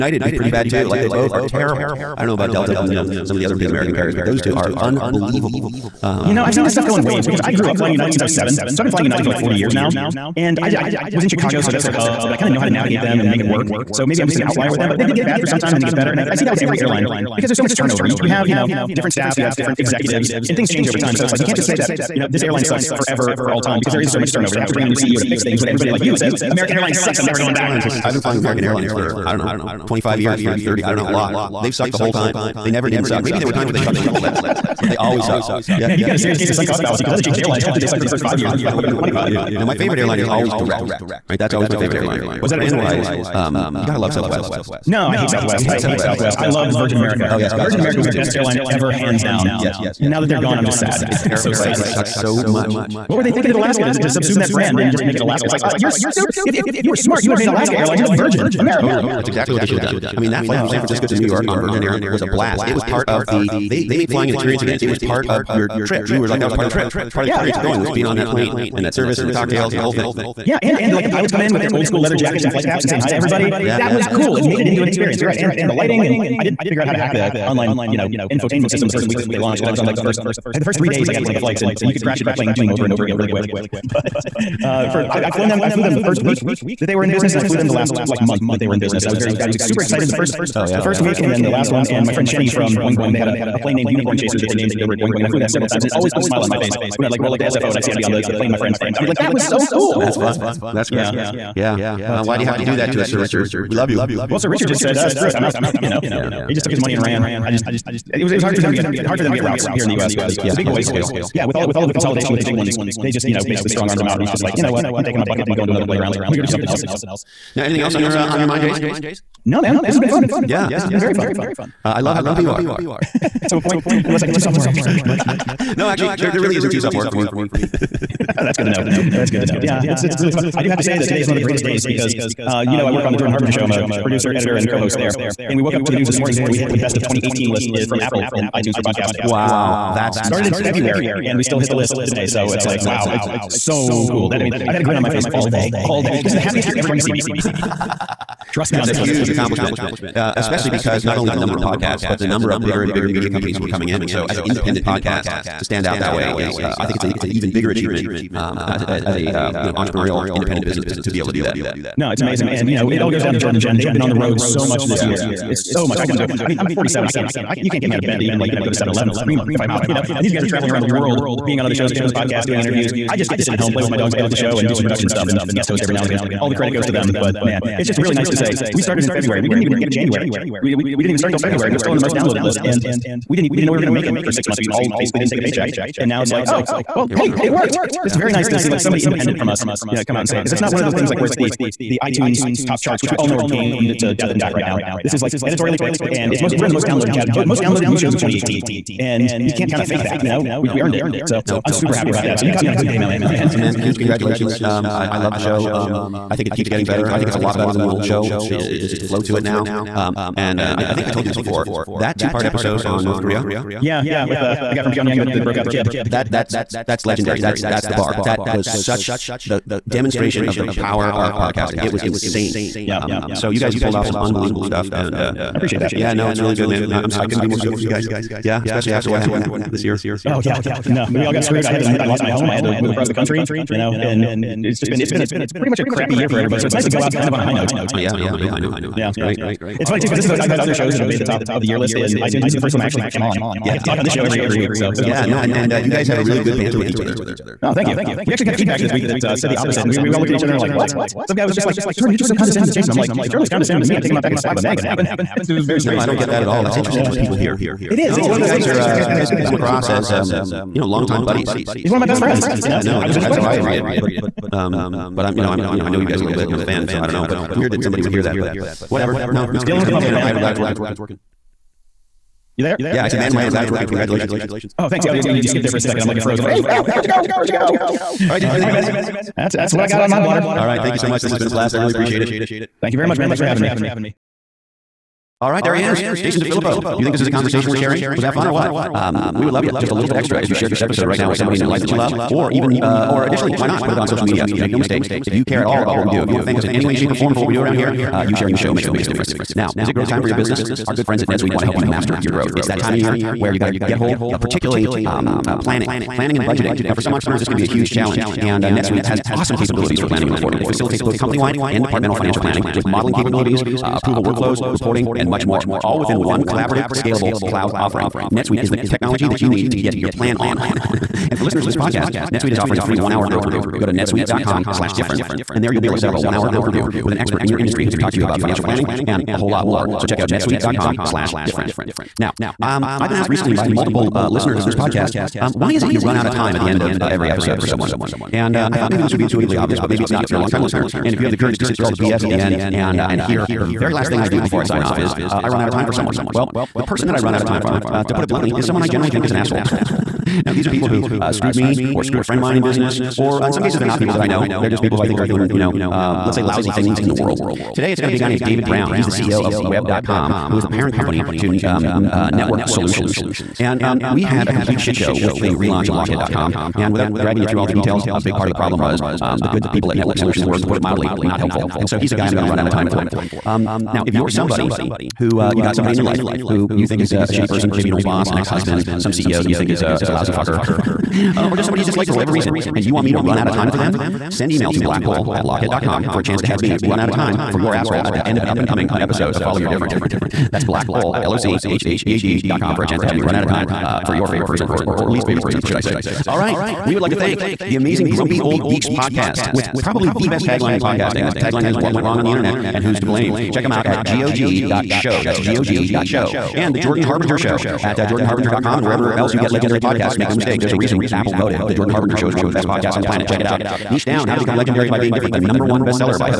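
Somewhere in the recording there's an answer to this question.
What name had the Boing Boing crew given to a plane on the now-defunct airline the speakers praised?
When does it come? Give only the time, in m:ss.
1:33.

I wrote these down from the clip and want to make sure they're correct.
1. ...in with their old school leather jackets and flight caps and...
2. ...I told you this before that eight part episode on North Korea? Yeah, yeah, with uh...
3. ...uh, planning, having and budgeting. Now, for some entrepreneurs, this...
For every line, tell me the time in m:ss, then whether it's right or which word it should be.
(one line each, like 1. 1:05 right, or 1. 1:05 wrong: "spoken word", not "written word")
1. 1:11 right
2. 3:31 wrong: "two", not "eight"
3. 5:05 wrong: "planning", not "having".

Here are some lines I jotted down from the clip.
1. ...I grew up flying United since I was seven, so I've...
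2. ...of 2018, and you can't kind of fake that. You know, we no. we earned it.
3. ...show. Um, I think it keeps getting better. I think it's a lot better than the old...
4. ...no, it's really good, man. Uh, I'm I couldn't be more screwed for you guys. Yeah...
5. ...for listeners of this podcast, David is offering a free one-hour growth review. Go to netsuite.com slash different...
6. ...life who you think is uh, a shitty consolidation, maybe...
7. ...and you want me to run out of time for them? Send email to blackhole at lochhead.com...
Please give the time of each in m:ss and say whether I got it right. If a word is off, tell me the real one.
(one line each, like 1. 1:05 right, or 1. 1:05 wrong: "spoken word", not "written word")
1. 0:07 right
2. 3:18 right
3. 3:25 right
4. 3:46 wrong: "stoked", not "screwed"
5. 5:21 wrong: "NetSuite", not "David"
6. 6:16 wrong: "person", not "consolidation"
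7. 6:22 right.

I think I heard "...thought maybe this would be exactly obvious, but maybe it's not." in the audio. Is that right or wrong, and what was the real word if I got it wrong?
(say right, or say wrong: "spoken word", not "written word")
wrong: "intuitively", not "exactly".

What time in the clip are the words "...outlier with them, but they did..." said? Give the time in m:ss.
0:14.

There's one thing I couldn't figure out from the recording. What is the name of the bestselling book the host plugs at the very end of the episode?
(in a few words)
Niche Down.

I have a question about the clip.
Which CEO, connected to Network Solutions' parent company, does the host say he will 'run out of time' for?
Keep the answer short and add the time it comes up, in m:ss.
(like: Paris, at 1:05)
David Brown, at 5:58.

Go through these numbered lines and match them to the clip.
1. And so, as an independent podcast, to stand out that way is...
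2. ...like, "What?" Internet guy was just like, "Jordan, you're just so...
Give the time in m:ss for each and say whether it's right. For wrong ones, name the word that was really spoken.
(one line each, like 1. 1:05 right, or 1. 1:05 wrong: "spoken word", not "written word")
1. 2:34 right
2. 4:10 wrong: "Some", not "Internet".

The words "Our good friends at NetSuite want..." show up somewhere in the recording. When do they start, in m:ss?
5:00.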